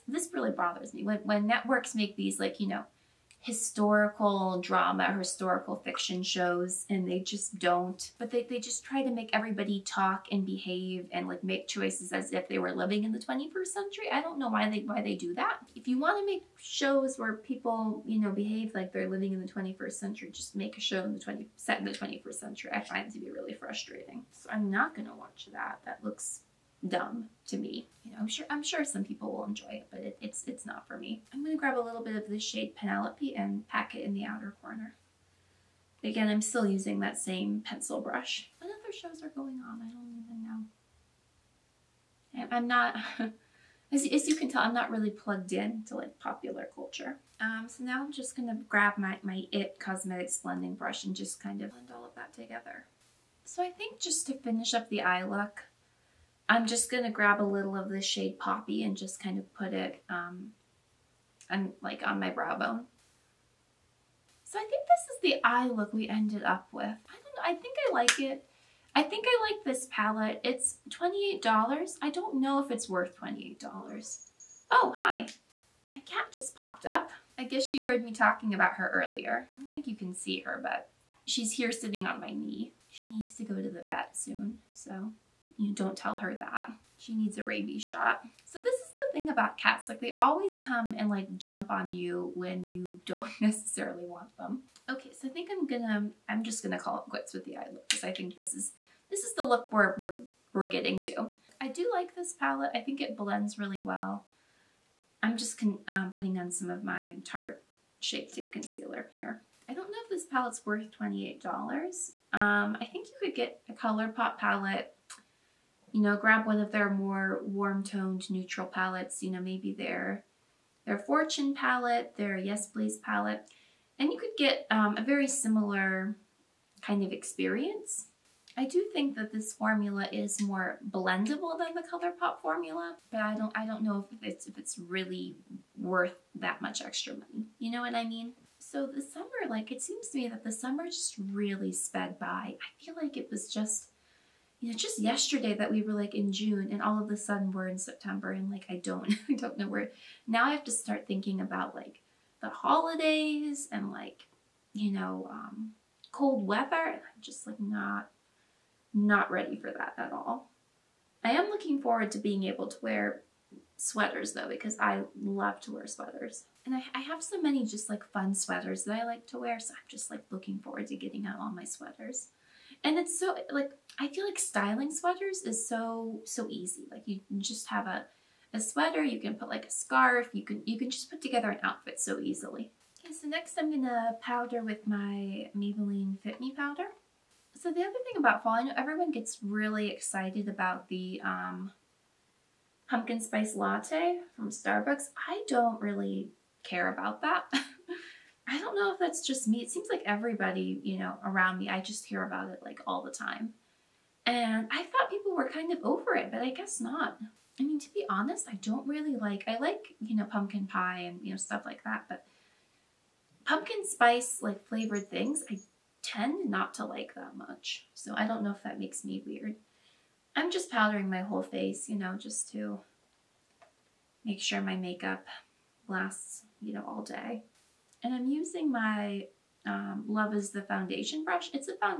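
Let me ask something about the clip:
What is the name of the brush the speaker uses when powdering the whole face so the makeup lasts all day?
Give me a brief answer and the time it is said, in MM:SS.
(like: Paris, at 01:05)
Love is the Foundation, at 03:50.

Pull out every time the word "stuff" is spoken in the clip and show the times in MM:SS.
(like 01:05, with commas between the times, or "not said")
03:31.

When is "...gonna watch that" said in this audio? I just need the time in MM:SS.
00:24.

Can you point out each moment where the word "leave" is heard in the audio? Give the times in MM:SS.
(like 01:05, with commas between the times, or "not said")
not said.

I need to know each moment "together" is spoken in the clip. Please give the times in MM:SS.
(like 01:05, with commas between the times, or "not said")
00:52, 03:01.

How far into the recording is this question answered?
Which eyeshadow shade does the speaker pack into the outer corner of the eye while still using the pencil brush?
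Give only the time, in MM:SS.
00:32.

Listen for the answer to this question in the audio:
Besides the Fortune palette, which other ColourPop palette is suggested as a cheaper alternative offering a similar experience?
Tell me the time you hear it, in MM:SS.
02:02.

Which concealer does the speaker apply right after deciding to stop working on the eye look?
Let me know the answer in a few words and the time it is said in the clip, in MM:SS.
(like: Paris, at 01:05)
Tarte Shape Tape, at 01:47.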